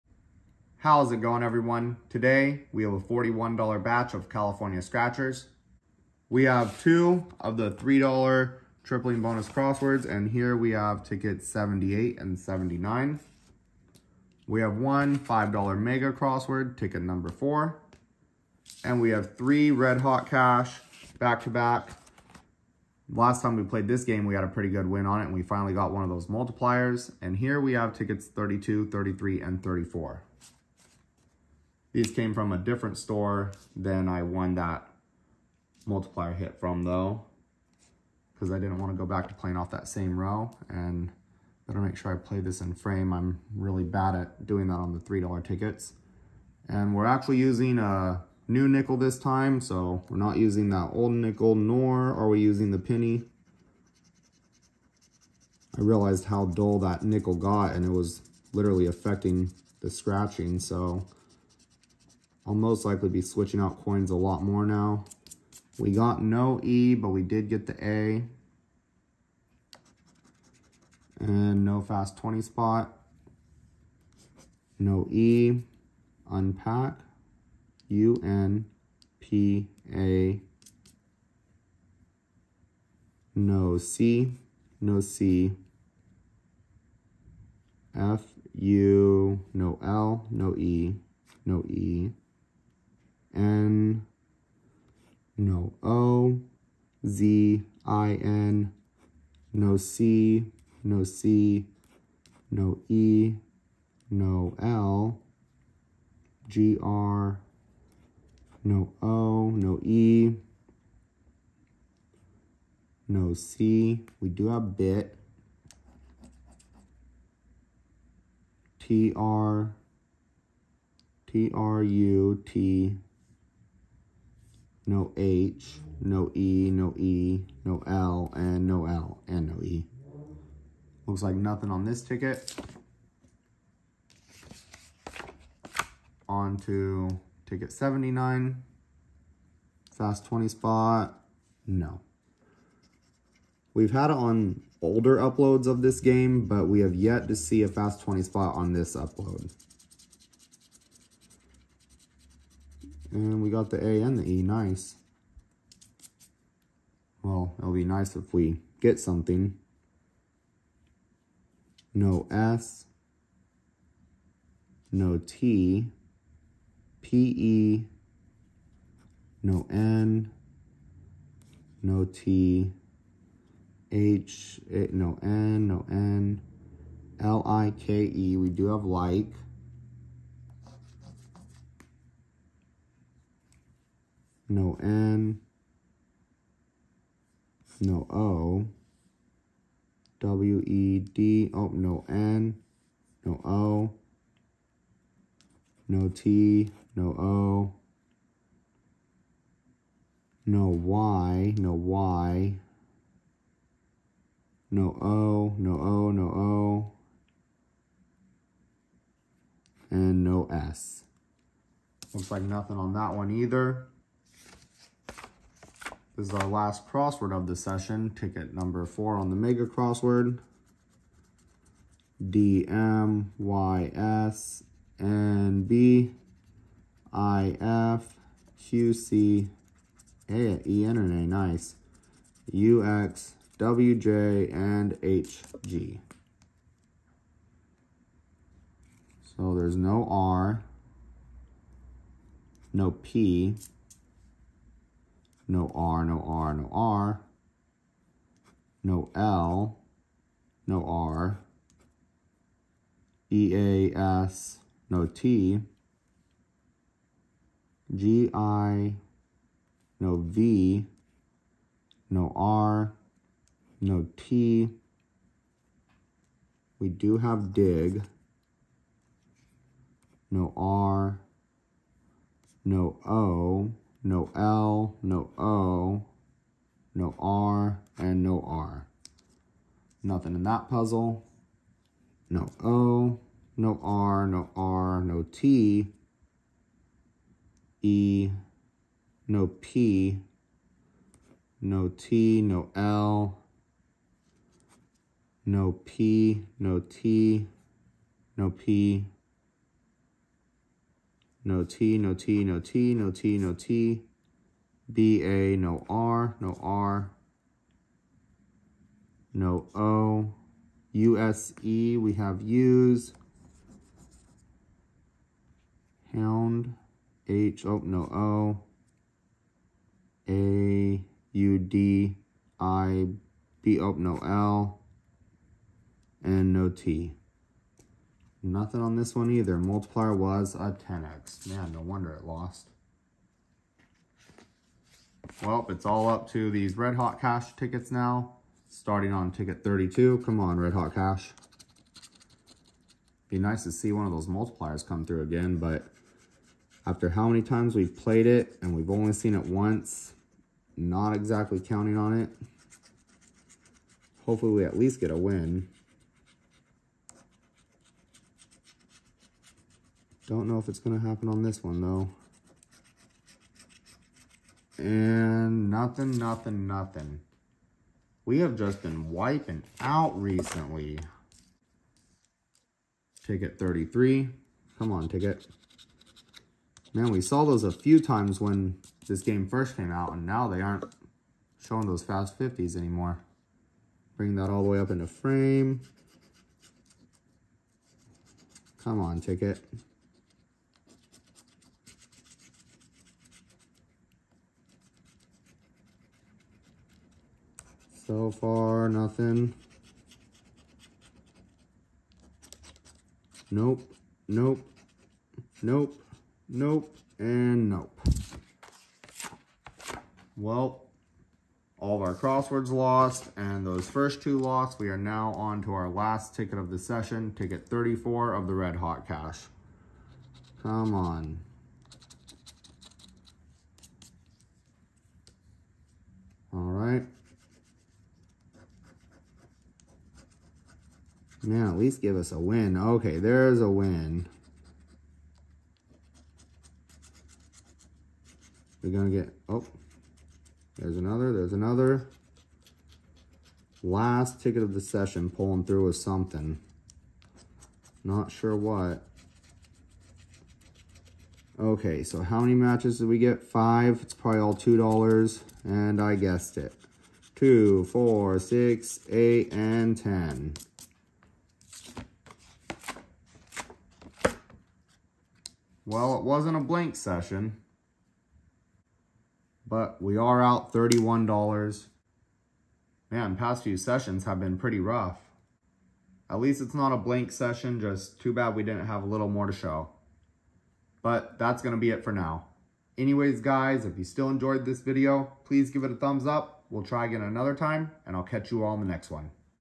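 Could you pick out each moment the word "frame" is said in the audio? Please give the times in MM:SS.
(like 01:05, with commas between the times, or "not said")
00:42, 06:25.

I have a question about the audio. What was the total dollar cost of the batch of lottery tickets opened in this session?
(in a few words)
$41.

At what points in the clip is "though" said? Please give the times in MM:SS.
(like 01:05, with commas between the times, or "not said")
00:36, 06:01.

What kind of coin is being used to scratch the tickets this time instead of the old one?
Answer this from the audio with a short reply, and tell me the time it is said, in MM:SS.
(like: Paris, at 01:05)
A new nickel, at 00:48.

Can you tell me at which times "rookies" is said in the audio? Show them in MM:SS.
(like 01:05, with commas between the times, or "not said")
not said.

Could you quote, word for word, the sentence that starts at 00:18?
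And we have three red hot cash back to back.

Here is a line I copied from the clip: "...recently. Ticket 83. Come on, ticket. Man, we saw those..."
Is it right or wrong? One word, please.
wrong.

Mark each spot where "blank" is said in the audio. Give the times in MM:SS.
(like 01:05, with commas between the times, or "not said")
07:46, 07:56.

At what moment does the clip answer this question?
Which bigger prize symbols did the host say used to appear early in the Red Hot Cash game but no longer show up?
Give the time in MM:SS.
06:22.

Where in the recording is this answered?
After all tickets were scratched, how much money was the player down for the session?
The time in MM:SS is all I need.
07:50.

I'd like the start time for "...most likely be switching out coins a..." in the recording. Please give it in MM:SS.
01:02.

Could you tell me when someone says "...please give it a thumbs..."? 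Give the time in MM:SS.
08:05.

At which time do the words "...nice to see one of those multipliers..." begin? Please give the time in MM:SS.
05:43.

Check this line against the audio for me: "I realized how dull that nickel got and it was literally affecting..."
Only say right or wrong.
right.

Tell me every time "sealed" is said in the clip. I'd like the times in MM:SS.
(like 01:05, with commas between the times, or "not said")
not said.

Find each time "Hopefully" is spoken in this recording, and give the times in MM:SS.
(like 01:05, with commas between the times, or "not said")
05:54.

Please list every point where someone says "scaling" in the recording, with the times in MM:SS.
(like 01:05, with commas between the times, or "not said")
not said.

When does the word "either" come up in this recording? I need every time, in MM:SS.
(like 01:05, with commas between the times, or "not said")
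03:33, 05:29.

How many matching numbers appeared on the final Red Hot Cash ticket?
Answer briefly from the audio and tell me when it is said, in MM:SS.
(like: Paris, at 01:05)
Five, at 07:33.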